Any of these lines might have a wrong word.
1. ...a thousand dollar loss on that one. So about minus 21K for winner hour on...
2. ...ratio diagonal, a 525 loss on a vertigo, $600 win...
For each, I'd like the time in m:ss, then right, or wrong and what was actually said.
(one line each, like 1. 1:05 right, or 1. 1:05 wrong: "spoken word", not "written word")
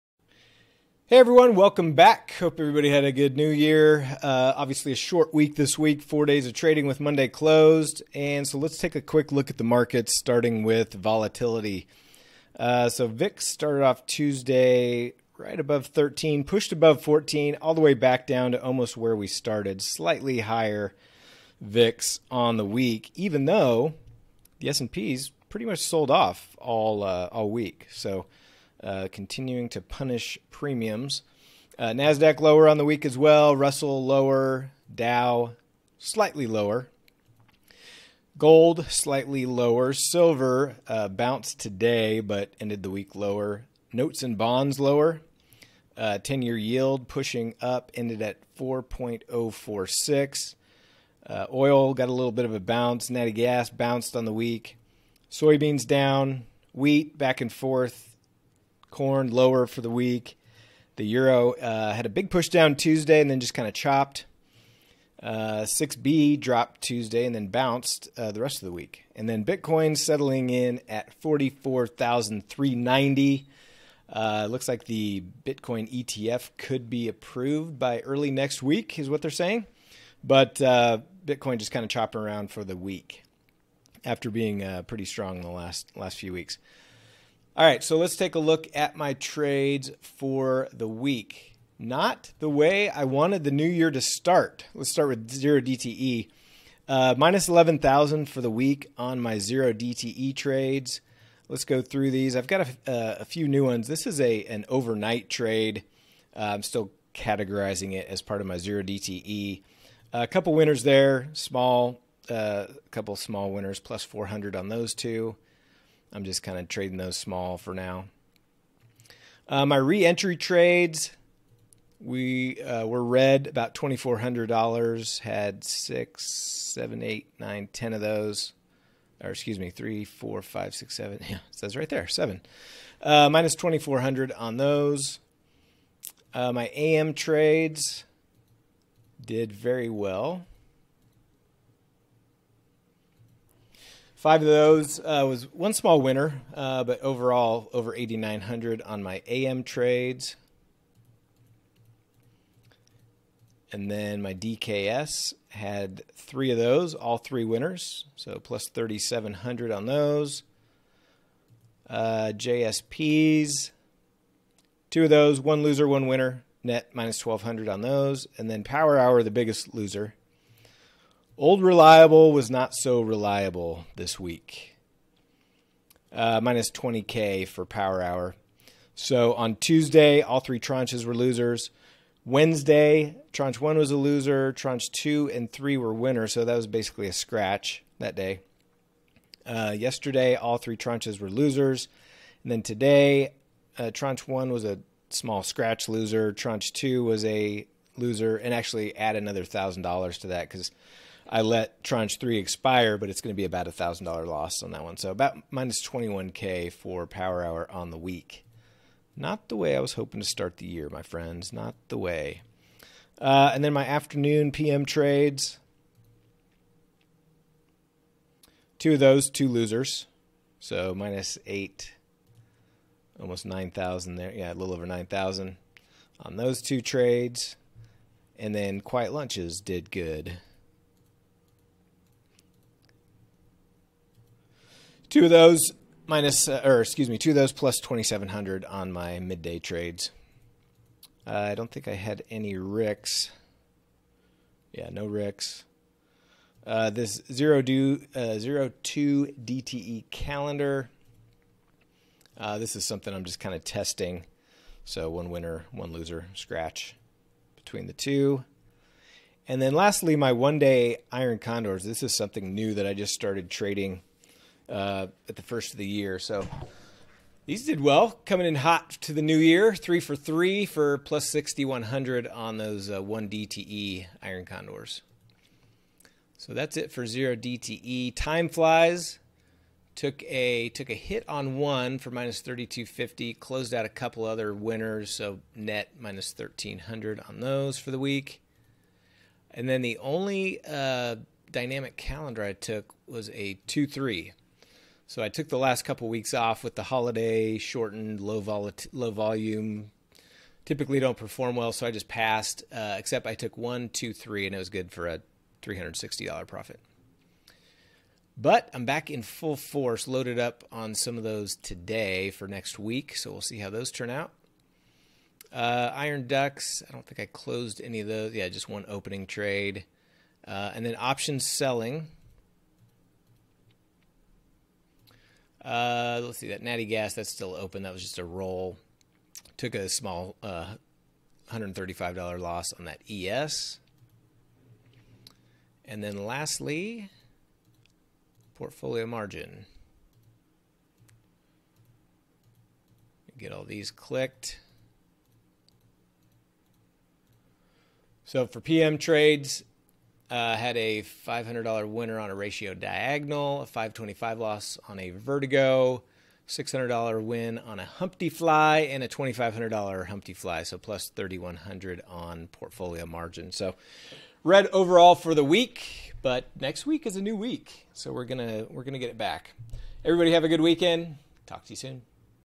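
1. 3:23 wrong: "power", not "winner"
2. 5:52 right.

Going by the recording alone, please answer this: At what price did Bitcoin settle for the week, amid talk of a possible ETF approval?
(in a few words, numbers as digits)
44,390.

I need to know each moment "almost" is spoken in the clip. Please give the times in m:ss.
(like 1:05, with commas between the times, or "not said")
0:18, 3:43.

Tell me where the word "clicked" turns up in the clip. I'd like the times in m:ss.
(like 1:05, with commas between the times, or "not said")
5:43.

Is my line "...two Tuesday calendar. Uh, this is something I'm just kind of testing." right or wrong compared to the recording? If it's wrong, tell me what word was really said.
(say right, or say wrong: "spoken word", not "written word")
wrong: "DTE", not "Tuesday".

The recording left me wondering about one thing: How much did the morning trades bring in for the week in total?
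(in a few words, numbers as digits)
Over 8,900.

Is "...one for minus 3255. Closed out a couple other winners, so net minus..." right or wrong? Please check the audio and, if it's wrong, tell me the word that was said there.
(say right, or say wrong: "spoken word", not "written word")
wrong: "3250", not "3255".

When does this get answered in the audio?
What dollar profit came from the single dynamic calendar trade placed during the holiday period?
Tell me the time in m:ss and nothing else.
5:05.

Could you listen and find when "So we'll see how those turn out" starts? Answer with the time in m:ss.
5:13.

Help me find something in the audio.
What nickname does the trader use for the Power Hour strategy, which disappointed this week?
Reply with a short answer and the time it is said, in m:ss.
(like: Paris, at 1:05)
Old Reliable, at 2:51.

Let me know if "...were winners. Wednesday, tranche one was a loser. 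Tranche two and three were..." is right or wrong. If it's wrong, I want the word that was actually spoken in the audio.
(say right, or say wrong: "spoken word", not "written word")
wrong: "losers", not "winners".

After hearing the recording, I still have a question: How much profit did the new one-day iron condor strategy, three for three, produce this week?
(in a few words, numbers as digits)
6,100.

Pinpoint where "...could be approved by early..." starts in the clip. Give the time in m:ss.
1:16.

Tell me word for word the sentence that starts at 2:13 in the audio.
Uh, minus twenty four hundred on those.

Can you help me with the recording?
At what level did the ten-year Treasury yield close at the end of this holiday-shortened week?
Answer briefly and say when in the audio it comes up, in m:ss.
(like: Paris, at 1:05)
4.046, at 0:48.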